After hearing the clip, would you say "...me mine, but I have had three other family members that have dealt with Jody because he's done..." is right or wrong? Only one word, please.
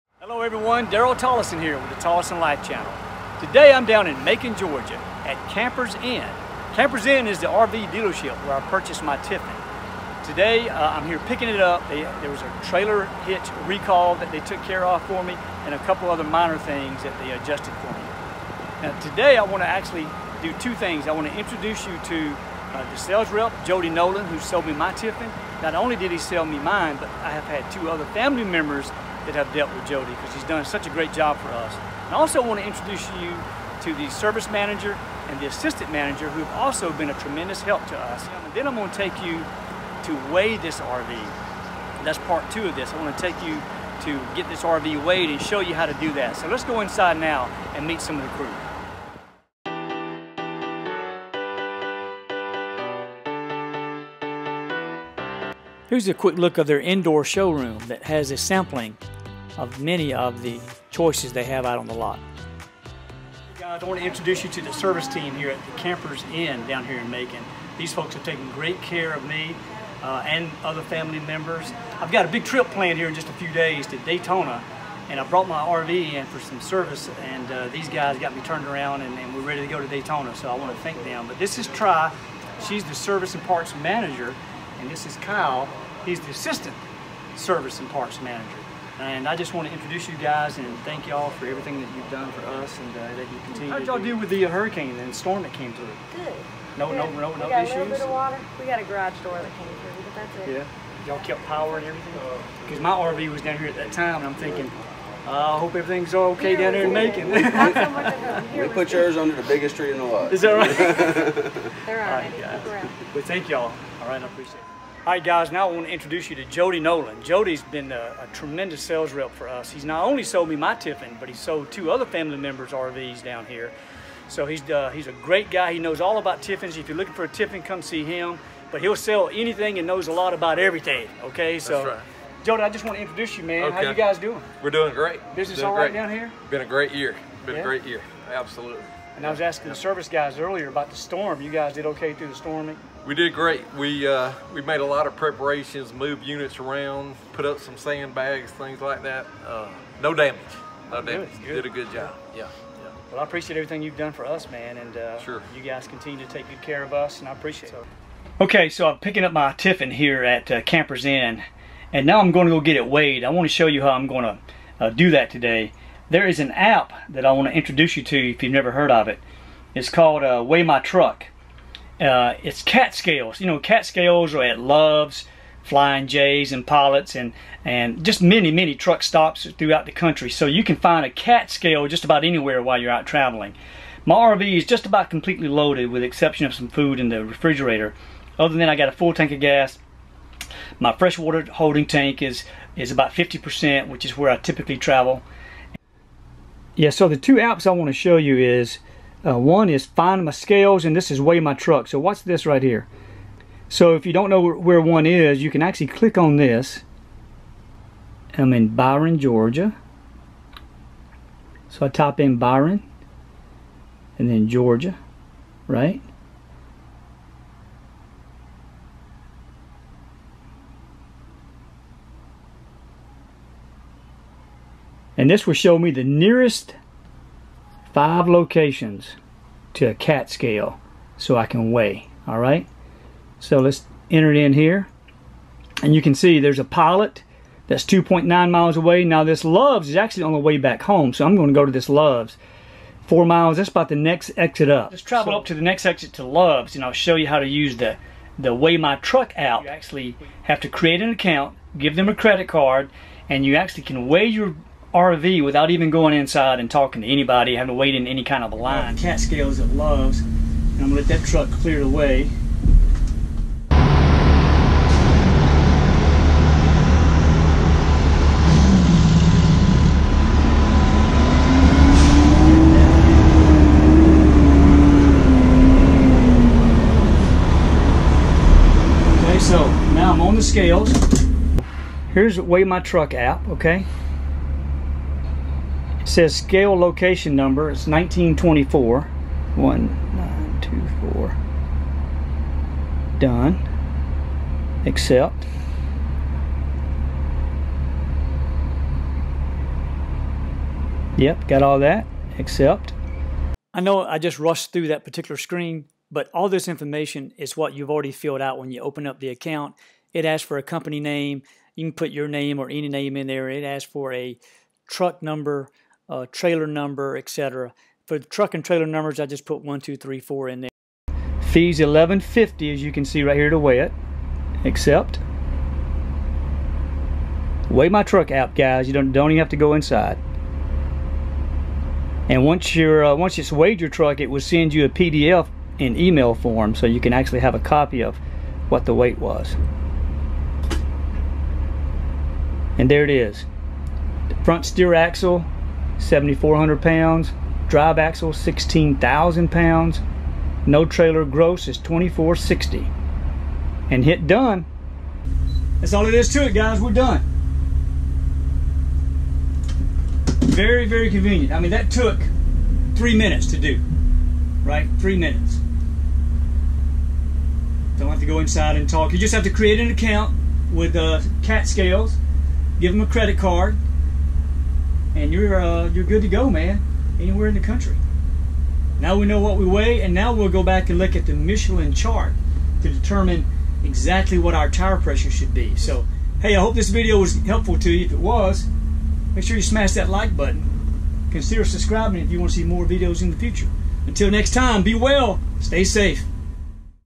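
wrong.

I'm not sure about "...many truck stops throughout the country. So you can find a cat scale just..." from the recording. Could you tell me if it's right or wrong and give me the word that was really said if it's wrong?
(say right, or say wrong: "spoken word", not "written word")
right.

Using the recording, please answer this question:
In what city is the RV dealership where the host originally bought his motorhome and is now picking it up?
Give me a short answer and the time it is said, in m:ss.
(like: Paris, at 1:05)
Macon, Georgia, at 0:04.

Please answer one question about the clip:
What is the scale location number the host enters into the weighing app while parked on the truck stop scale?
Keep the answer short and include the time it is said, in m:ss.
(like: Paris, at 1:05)
1924, at 4:47.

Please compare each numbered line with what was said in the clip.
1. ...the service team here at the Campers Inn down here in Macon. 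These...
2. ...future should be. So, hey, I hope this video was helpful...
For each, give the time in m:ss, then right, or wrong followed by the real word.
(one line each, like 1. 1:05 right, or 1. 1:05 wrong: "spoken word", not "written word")
1. 1:04 right
2. 6:24 wrong: "pressure", not "future".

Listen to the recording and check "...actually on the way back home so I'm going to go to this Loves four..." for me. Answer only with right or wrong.
right.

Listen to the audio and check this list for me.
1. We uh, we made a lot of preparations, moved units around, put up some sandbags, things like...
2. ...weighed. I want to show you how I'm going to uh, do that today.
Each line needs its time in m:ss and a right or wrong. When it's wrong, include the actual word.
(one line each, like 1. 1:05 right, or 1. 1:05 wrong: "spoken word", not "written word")
1. 2:23 right
2. 2:42 right.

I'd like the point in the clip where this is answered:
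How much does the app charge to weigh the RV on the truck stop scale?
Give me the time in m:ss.
5:21.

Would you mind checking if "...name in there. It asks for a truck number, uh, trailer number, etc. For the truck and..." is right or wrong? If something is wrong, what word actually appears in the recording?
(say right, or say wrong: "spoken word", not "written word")
right.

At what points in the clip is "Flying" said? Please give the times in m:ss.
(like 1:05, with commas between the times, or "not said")
2:55.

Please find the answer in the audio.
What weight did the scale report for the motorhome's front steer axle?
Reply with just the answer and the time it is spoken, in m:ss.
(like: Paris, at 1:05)
7,400 pounds, at 5:46.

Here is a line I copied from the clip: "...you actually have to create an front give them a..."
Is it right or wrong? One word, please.
wrong.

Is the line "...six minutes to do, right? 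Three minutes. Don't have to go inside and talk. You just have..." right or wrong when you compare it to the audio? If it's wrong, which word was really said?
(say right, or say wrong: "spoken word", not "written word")
wrong: "three", not "six".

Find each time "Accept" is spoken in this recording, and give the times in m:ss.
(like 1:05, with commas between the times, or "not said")
4:54, 5:02.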